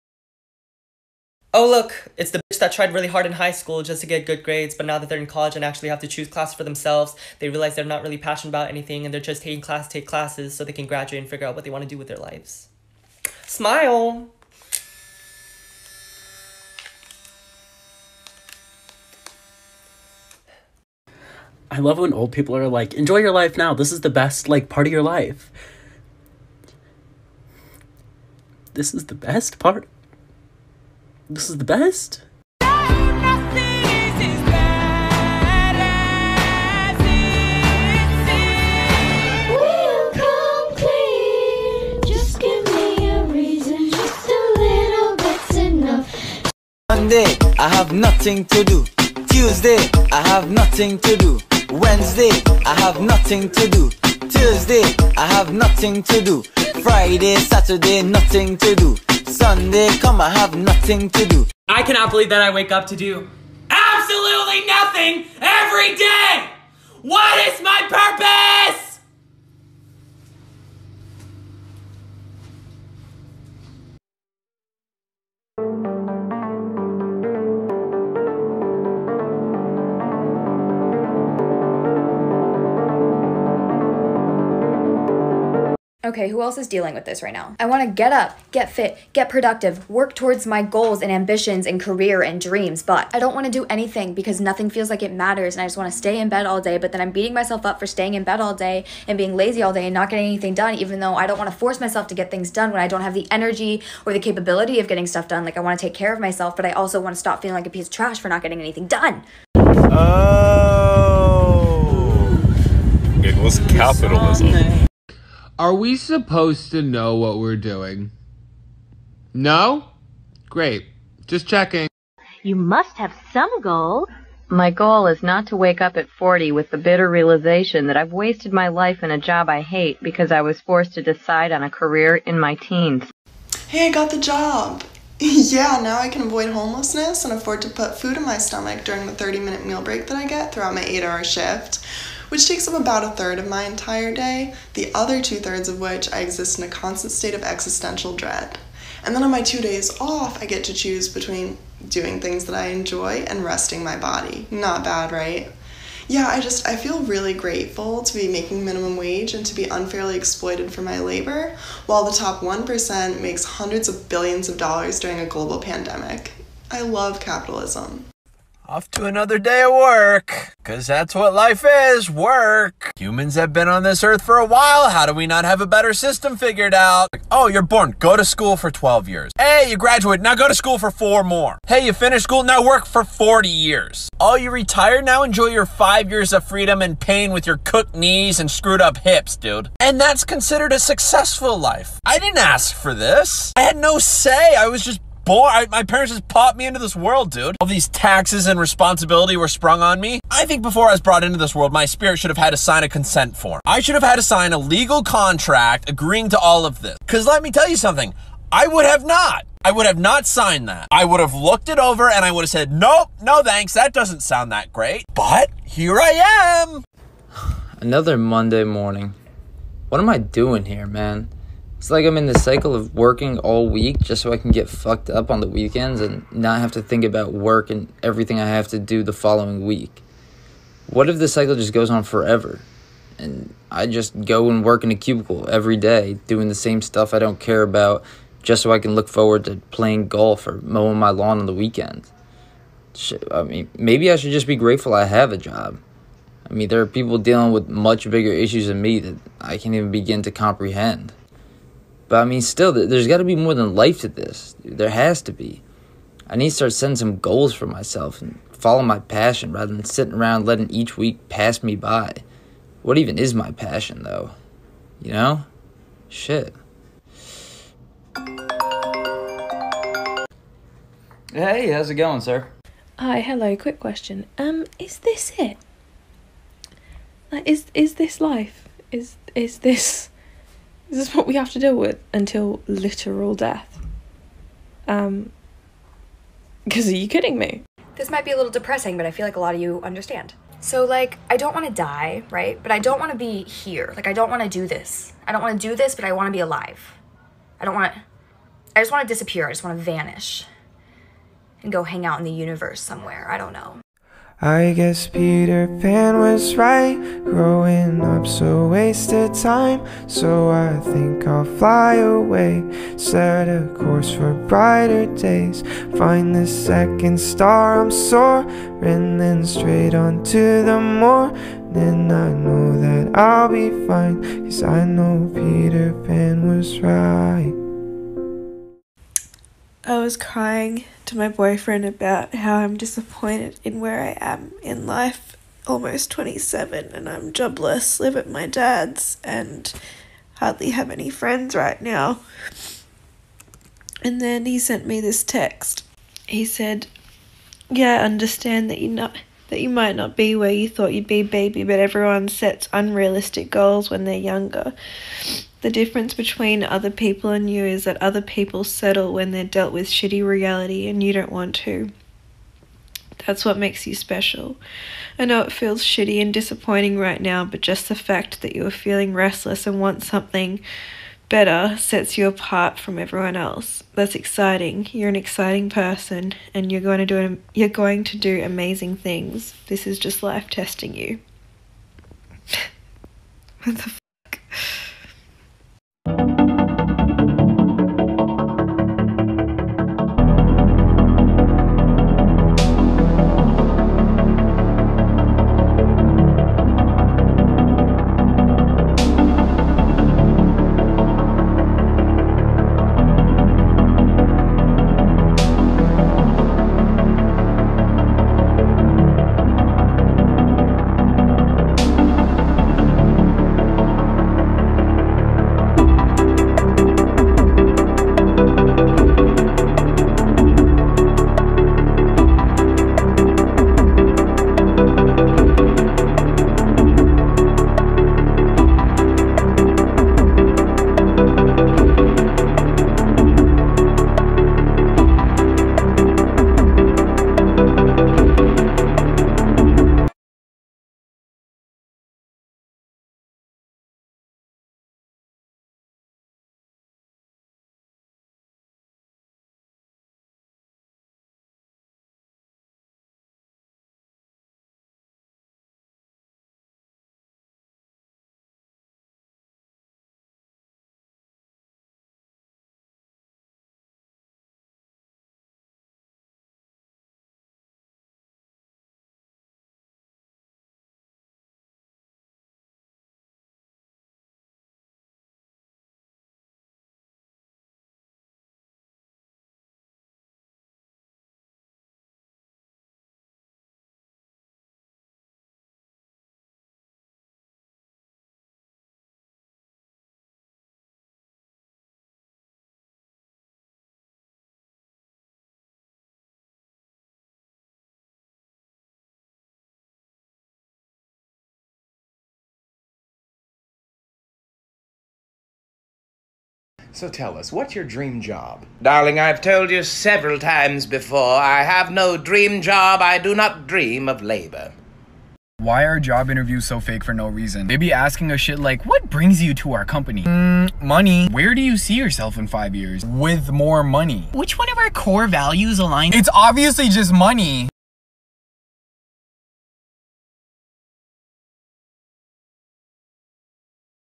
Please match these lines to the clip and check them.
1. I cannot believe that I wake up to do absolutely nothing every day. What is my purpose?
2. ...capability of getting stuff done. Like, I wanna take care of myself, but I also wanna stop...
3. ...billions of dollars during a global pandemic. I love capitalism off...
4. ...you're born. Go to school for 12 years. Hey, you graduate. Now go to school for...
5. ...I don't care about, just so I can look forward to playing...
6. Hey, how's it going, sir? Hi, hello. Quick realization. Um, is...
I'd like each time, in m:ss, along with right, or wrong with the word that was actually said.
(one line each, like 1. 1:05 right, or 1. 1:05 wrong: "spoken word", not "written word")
1. 1:01 right
2. 1:44 right
3. 2:44 right
4. 2:57 right
5. 3:57 right
6. 4:31 wrong: "question", not "realization".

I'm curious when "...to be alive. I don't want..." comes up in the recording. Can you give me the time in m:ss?
4:56.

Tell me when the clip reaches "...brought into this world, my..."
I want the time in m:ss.
3:21.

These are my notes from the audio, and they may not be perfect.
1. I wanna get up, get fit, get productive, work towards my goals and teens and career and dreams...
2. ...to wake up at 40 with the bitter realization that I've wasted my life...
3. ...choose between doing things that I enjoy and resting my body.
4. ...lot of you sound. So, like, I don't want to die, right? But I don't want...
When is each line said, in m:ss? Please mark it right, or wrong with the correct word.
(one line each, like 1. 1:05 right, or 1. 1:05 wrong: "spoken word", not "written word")
1. 1:27 wrong: "ambitions", not "teens"
2. 2:05 right
3. 2:30 right
4. 4:49 wrong: "understand", not "sound".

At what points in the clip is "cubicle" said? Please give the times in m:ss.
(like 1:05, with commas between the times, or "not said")
3:54.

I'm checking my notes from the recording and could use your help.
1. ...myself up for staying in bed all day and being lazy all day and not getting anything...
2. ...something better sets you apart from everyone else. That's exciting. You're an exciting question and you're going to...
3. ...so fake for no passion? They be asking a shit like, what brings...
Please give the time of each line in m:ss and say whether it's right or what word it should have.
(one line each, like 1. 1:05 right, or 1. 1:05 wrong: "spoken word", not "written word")
1. 1:37 right
2. 6:10 wrong: "person", not "question"
3. 8:36 wrong: "reason", not "passion".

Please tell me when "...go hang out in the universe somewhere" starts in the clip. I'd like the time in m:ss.
5:01.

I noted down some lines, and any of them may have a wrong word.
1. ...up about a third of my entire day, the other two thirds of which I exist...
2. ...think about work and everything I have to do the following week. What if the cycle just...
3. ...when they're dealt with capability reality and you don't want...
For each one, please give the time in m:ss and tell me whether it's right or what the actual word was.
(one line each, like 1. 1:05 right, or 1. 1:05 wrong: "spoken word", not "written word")
1. 2:22 right
2. 3:46 right
3. 5:59 wrong: "shitty", not "capability".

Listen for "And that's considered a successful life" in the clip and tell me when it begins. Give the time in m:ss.
3:09.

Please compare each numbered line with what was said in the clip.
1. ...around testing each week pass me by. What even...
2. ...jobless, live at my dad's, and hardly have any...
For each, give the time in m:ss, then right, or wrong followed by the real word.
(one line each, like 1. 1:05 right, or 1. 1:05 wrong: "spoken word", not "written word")
1. 4:20 wrong: "letting", not "testing"
2. 5:37 right.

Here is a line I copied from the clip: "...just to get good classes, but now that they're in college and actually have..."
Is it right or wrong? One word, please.
wrong.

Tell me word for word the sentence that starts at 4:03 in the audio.
I mean, maybe I should just be grateful I have a job.